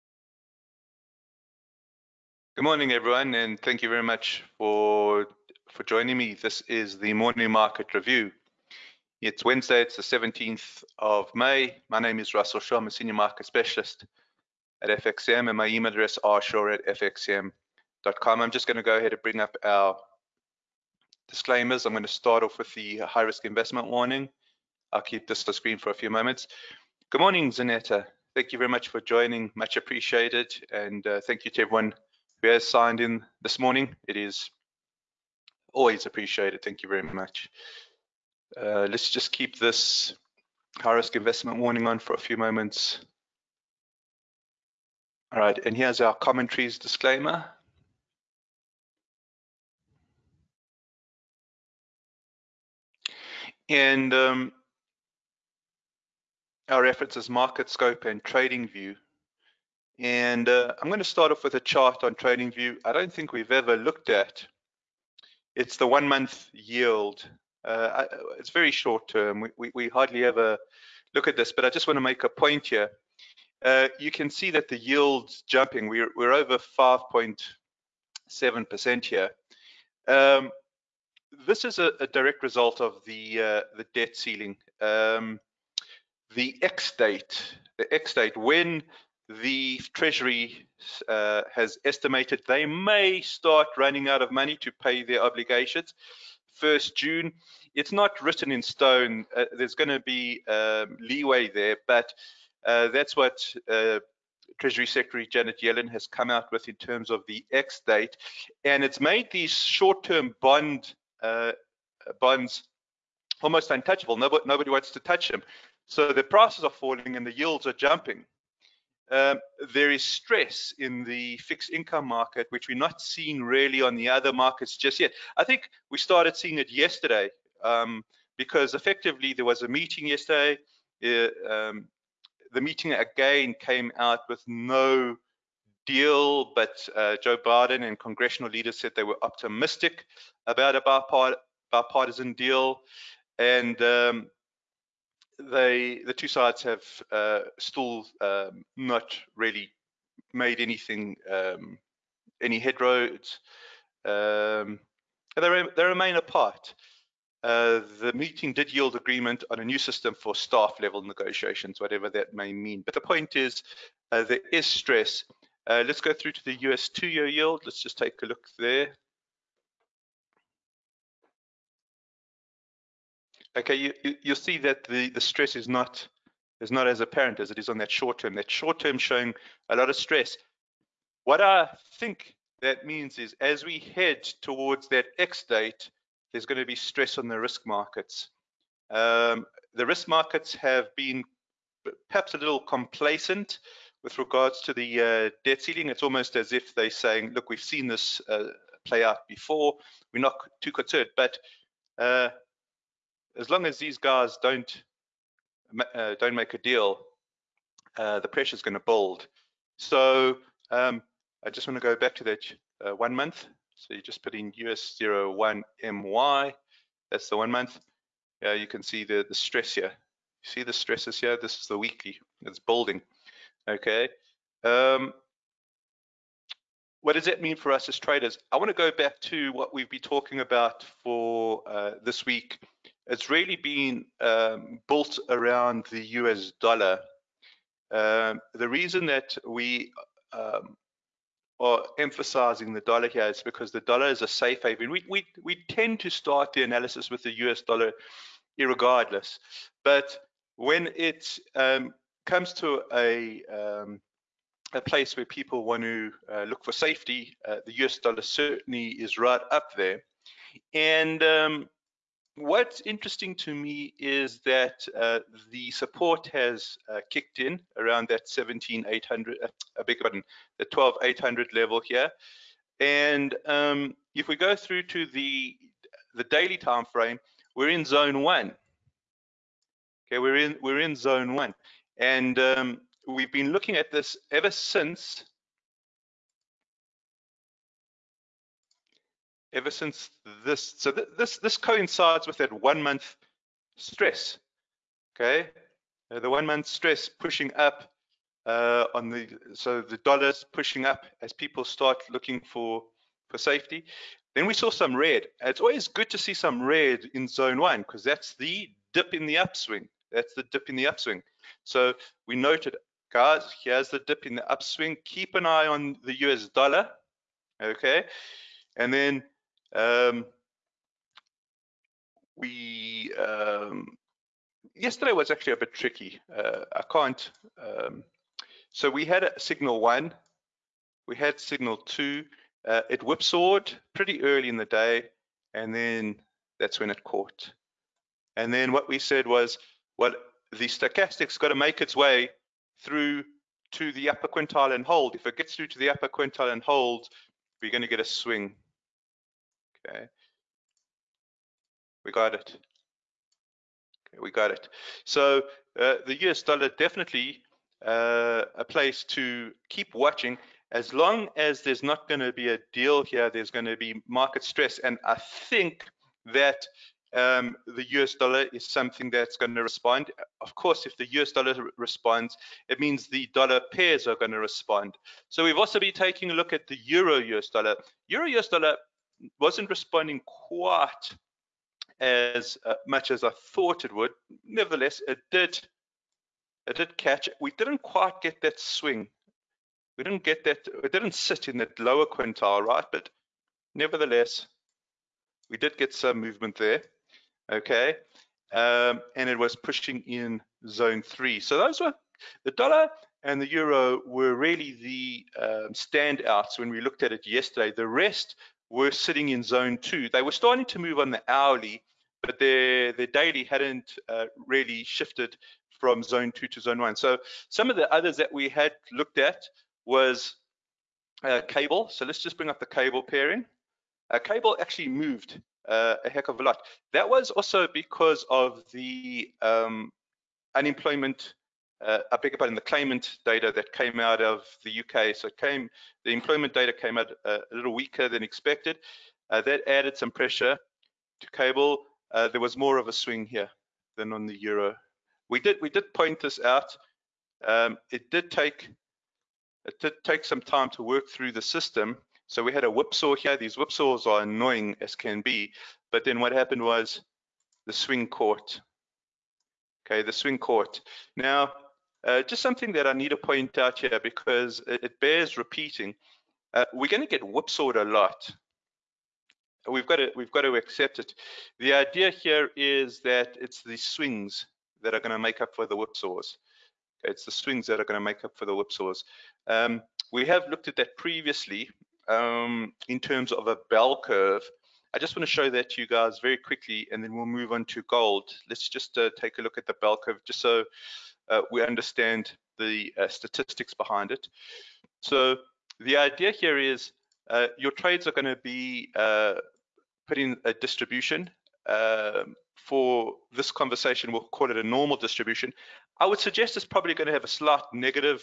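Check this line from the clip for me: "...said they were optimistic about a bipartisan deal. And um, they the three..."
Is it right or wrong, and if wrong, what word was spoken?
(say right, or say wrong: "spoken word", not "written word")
wrong: "two", not "three".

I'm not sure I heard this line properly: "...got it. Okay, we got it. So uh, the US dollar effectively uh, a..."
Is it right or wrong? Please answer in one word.
wrong.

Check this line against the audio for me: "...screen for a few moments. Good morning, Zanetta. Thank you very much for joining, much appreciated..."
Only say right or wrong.
right.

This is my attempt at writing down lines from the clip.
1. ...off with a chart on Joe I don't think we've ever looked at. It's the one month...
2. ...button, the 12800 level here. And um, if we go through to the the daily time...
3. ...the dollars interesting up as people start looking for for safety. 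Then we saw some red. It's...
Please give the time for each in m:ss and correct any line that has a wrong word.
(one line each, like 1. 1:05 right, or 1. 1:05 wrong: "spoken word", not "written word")
1. 1:01 wrong: "TradingView", not "Joe"
2. 4:30 right
3. 4:59 wrong: "pushing", not "interesting".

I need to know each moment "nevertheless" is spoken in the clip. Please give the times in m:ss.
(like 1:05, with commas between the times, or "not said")
6:24, 6:33.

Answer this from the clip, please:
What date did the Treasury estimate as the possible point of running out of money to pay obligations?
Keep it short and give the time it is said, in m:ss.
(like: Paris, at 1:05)
1st June, at 1:36.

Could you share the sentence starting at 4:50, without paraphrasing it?
So th this this coincides with that one month stress.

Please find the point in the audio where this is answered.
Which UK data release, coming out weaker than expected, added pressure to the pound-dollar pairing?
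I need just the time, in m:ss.
7:12.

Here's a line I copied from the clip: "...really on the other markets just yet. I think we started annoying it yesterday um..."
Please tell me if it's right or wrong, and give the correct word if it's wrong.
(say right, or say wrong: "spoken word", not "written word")
wrong: "seeing", not "annoying".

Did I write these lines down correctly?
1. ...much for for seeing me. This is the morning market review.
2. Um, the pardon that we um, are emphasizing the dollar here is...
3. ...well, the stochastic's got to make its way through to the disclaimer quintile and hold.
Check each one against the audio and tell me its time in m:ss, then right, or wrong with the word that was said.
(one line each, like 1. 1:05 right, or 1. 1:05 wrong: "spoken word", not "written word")
1. 0:04 wrong: "joining", not "seeing"
2. 3:57 wrong: "reason", not "pardon"
3. 5:39 wrong: "upper", not "disclaimer".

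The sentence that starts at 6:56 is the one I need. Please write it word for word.
So some of the others that we had looked at was uh, cable.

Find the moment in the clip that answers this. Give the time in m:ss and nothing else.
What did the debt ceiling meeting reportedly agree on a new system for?
2:40.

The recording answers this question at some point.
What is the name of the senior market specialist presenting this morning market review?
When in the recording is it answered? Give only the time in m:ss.
0:12.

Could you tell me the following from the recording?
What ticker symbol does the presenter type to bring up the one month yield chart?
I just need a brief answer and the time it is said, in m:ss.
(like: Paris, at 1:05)
US01MY, at 3:34.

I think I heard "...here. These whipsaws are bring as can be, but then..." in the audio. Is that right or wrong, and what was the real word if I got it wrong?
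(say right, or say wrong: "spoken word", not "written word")
wrong: "annoying", not "bring".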